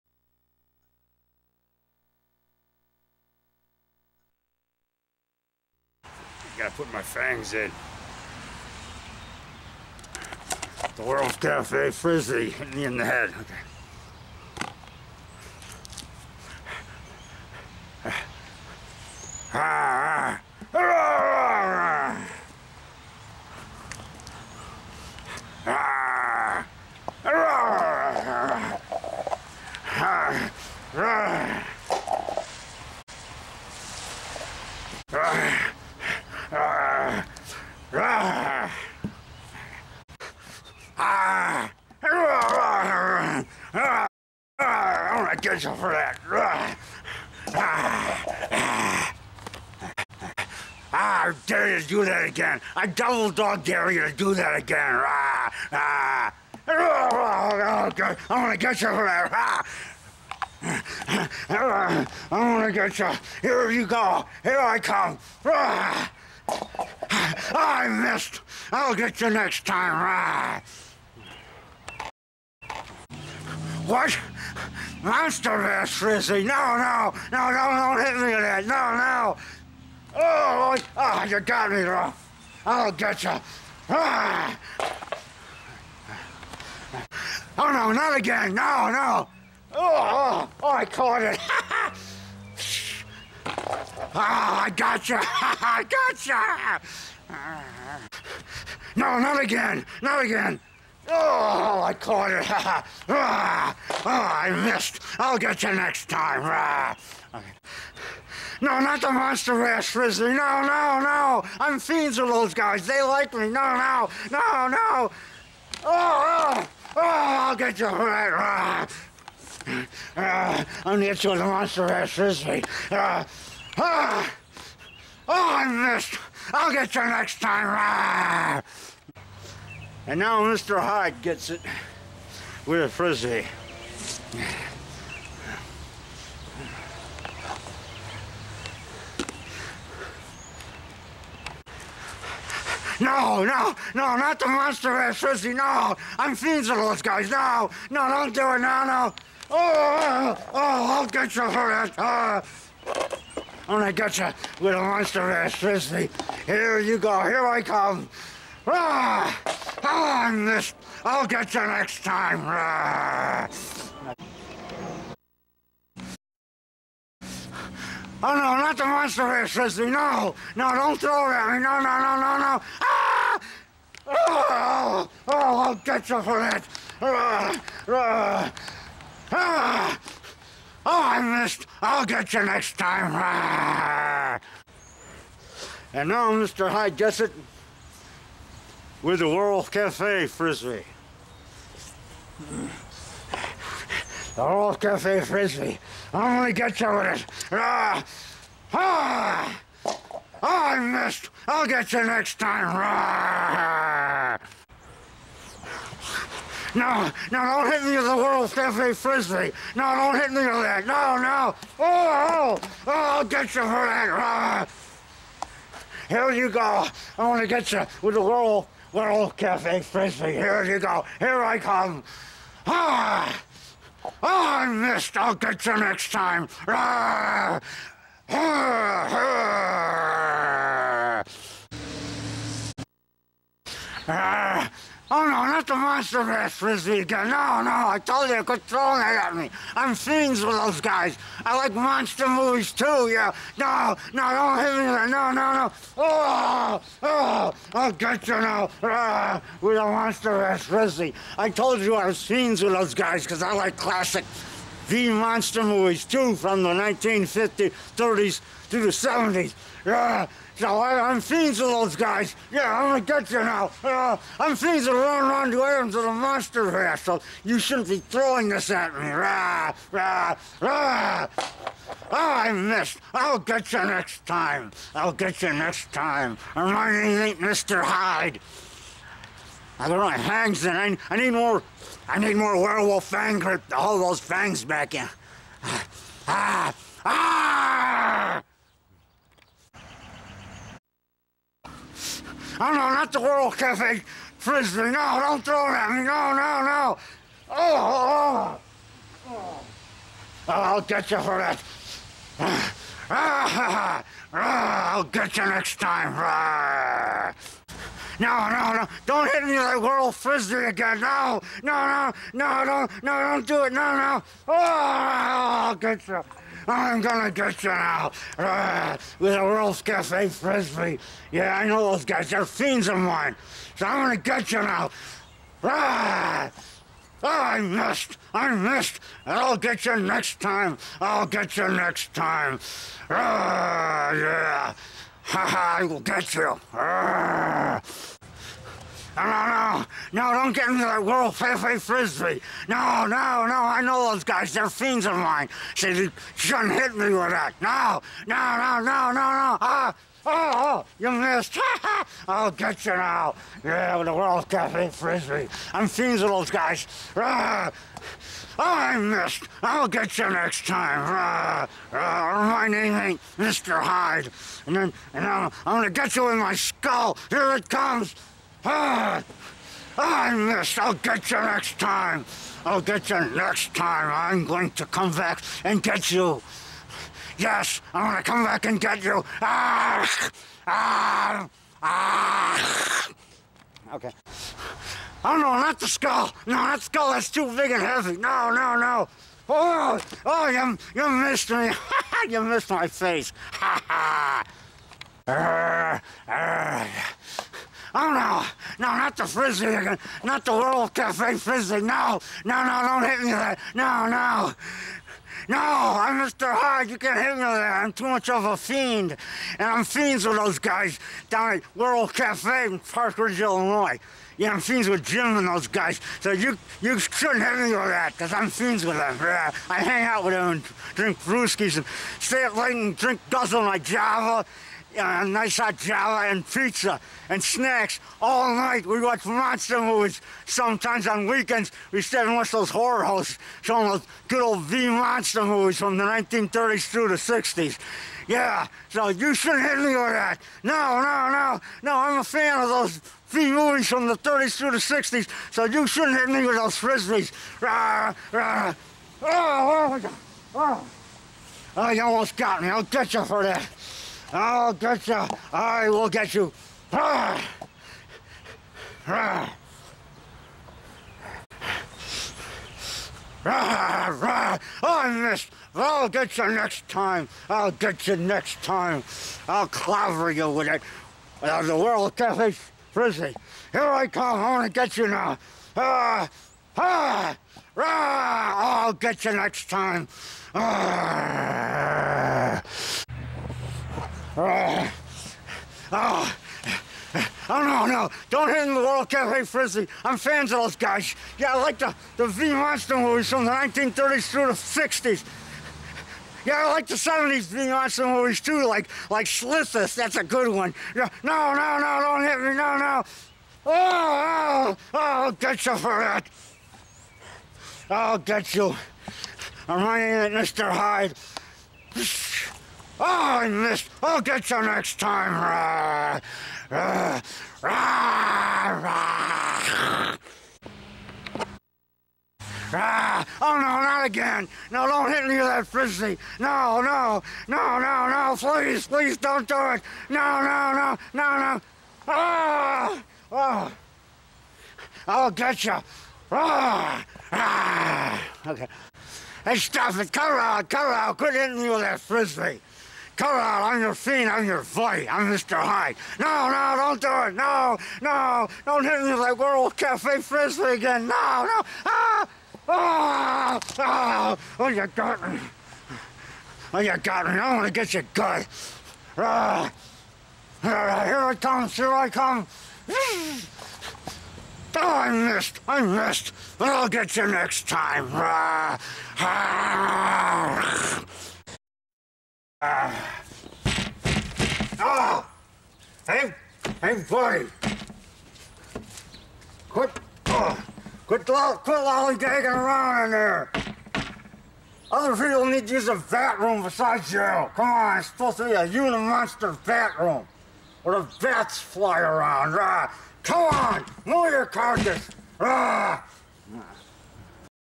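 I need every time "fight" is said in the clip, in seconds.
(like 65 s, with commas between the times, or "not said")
544 s.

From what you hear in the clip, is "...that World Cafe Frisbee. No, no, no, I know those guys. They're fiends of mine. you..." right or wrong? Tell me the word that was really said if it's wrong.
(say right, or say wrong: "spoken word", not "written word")
right.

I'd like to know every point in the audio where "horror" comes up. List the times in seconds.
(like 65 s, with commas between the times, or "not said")
432 s.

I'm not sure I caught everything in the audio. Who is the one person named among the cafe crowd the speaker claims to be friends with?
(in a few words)
Jim.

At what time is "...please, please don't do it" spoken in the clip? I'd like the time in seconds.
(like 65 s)
528 s.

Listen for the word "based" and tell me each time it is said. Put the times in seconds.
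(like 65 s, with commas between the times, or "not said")
not said.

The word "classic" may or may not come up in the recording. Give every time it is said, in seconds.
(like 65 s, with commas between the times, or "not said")
253 s.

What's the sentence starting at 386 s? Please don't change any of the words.
No, that skull, is too big and heavy.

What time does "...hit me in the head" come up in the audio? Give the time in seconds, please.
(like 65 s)
12 s.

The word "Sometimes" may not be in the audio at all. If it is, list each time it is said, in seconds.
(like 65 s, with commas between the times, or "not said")
430 s.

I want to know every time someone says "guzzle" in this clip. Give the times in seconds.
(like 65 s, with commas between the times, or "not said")
423 s.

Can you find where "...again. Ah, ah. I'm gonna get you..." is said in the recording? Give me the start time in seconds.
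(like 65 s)
54 s.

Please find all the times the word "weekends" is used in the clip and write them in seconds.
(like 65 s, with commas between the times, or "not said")
431 s.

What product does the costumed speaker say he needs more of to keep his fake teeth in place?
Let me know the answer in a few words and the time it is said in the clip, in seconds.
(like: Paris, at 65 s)
werewolf fang grip, at 282 s.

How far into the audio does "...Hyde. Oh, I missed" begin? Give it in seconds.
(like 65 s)
510 s.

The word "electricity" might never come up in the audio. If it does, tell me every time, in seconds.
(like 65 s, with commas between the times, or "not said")
155 s, 169 s.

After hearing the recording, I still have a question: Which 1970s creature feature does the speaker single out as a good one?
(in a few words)
Slithis.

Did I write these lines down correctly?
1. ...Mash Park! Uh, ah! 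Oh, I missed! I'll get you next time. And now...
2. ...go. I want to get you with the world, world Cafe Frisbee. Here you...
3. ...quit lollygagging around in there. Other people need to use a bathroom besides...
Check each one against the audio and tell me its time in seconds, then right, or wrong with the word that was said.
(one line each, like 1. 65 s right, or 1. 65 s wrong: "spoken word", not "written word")
1. 121 s wrong: "Frisbee", not "Park"
2. 216 s right
3. 581 s right.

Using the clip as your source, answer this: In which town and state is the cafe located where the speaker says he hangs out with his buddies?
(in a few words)
Park Ridge, Illinois.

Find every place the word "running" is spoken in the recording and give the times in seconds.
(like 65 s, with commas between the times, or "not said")
264 s, 509 s.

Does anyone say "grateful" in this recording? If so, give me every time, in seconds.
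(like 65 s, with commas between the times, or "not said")
45 s.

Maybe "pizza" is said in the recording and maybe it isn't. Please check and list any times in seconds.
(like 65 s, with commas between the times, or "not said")
426 s.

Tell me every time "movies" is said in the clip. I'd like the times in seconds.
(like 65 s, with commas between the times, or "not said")
242 s, 255 s, 429 s, 435 s, 443 s, 492 s, 498 s.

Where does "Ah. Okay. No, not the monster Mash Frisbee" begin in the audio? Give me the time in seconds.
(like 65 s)
106 s.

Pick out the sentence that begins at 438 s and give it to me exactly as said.
Yeah, so you shouldn't hit me with that.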